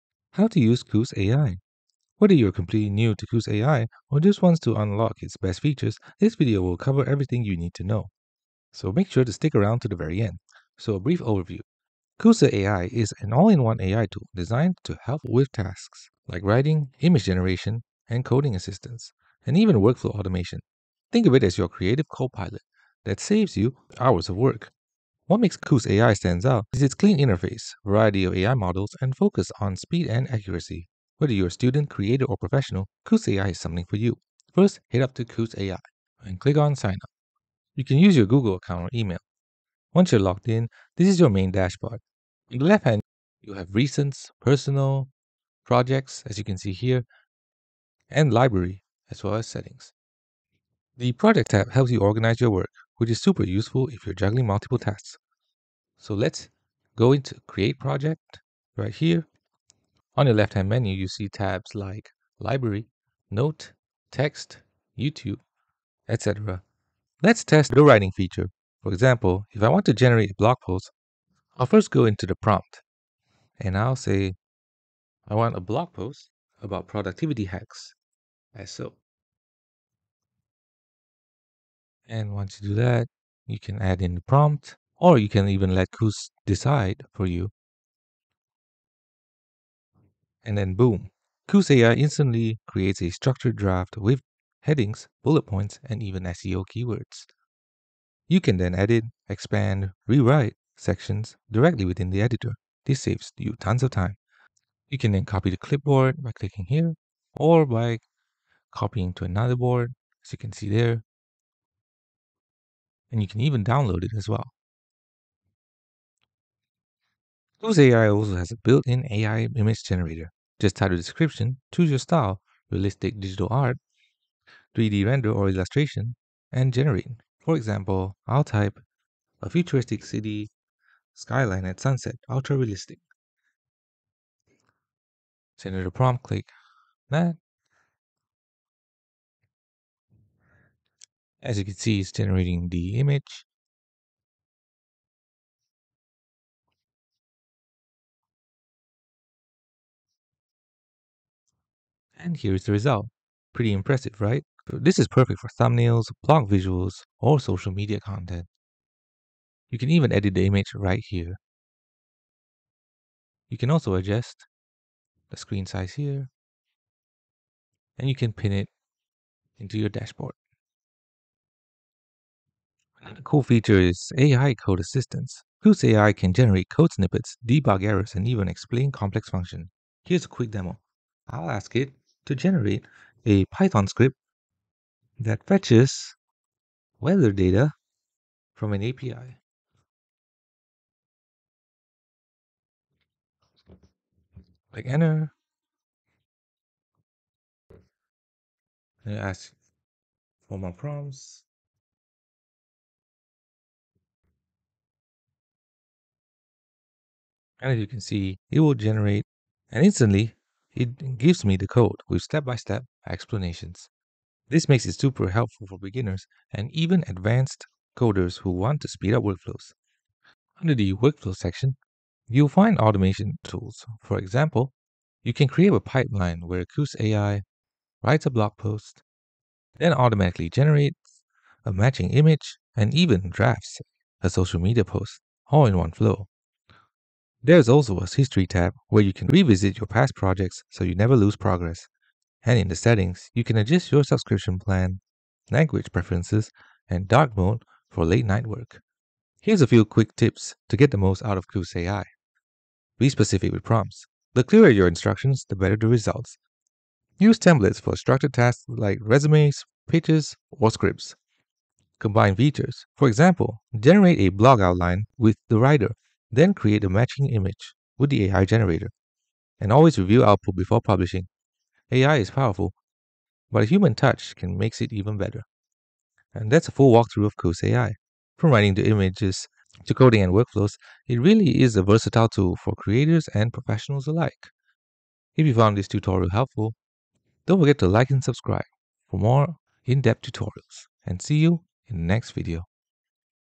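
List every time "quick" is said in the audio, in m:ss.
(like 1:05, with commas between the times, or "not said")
3:00, 4:09.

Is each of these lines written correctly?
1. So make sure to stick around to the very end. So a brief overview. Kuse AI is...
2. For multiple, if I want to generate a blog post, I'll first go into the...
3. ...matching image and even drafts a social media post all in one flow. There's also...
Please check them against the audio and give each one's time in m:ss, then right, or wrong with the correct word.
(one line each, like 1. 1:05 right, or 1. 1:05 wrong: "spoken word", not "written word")
1. 0:08 right
2. 1:08 wrong: "example", not "multiple"
3. 3:51 right.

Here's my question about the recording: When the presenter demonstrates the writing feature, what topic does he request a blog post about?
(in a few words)
productivity hacks.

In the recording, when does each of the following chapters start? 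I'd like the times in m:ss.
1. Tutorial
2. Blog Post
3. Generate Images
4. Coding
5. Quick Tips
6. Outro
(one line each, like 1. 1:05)
1. 0:34
2. 1:15
3. 1:57
4. 2:52
5. 4:09
6. 4:36.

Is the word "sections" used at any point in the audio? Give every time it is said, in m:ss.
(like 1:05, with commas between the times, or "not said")
1:40, 3:41.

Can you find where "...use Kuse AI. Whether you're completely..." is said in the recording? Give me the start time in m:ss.
0:00.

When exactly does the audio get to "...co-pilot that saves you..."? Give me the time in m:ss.
0:22.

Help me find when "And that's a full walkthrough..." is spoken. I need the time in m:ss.
4:36.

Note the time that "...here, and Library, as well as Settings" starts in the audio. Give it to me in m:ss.
0:46.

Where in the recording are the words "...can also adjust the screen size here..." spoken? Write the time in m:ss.
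2:43.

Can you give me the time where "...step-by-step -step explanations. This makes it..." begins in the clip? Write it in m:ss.
3:32.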